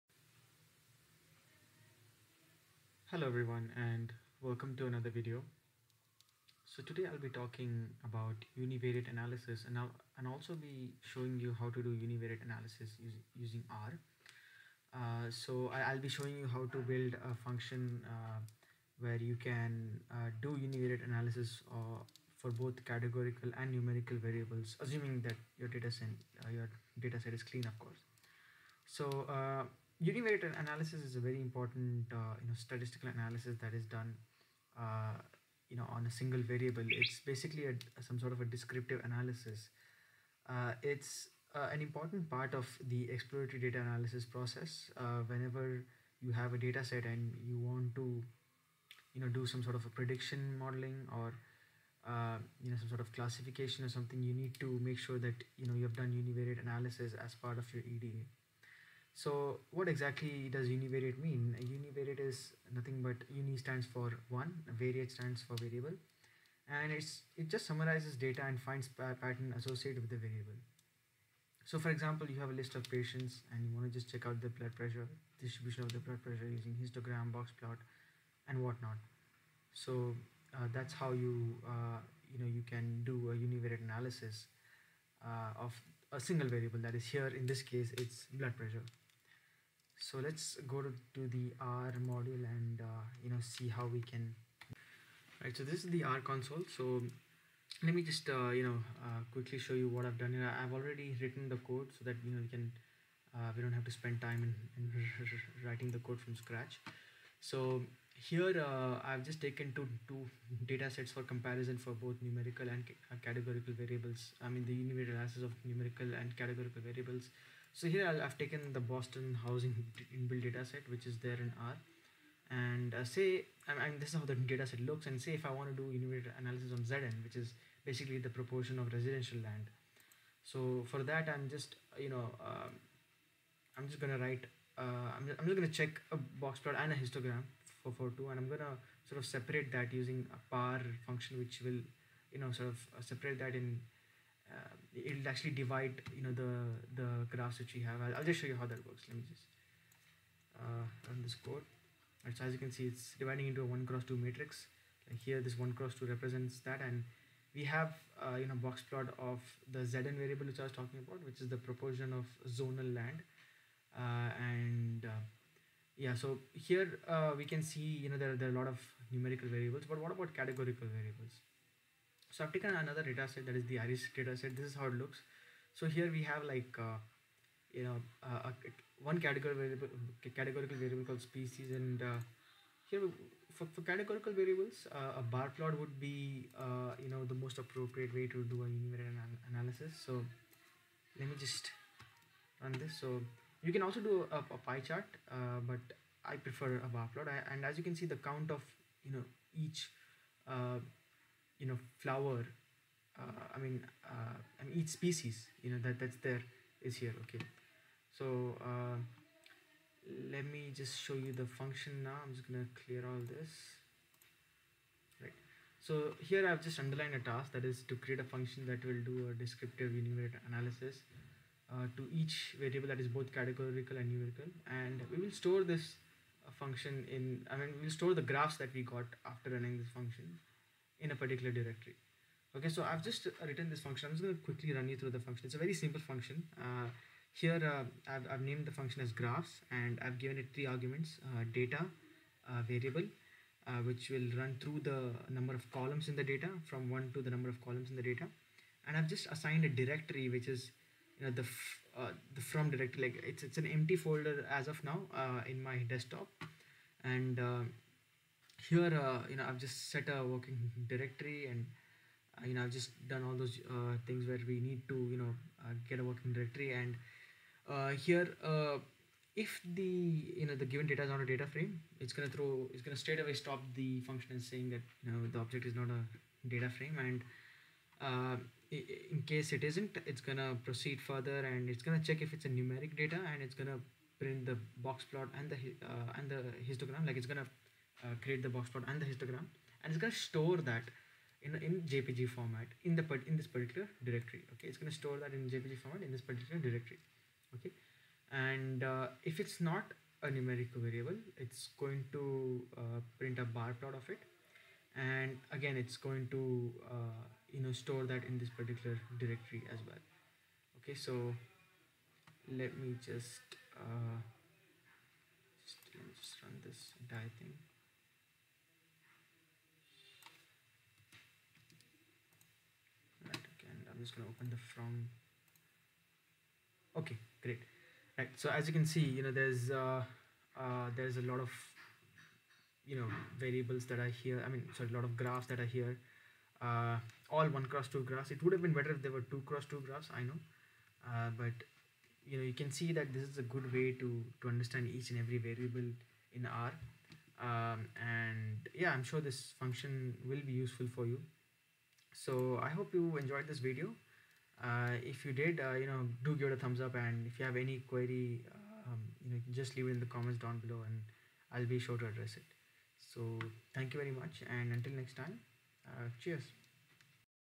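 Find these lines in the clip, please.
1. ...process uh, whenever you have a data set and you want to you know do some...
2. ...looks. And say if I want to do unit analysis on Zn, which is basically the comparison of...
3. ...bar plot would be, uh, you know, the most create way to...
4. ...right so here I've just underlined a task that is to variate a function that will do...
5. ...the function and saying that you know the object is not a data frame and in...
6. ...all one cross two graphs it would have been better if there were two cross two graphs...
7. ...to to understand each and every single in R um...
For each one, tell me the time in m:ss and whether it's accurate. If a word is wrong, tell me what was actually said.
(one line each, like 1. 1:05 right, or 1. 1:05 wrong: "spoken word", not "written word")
1. 0:44 right
2. 2:04 wrong: "proportion", not "comparison"
3. 3:05 wrong: "appropriate", not "create"
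4. 3:35 wrong: "create", not "variate"
5. 4:33 right
6. 5:37 right
7. 5:44 wrong: "variable", not "single".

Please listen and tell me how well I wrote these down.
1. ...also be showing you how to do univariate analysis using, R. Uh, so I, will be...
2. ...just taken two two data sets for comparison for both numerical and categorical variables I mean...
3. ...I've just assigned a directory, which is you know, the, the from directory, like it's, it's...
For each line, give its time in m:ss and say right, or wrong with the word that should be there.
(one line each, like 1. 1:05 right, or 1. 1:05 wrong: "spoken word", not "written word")
1. 0:10 right
2. 1:49 right
3. 4:08 right.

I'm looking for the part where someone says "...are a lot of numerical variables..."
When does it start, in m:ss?
2:48.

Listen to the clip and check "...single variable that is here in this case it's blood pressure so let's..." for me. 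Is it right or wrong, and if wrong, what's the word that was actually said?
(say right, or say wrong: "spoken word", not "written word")
right.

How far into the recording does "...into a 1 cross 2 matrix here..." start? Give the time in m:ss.
2:33.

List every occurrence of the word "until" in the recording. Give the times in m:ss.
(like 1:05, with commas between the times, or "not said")
6:04.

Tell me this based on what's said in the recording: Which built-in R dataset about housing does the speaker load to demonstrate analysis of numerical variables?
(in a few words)
Boston housing.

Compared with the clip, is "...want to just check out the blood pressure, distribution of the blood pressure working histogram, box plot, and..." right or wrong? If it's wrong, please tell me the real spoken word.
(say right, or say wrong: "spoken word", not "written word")
wrong: "using", not "working".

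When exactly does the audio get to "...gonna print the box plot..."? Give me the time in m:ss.
4:43.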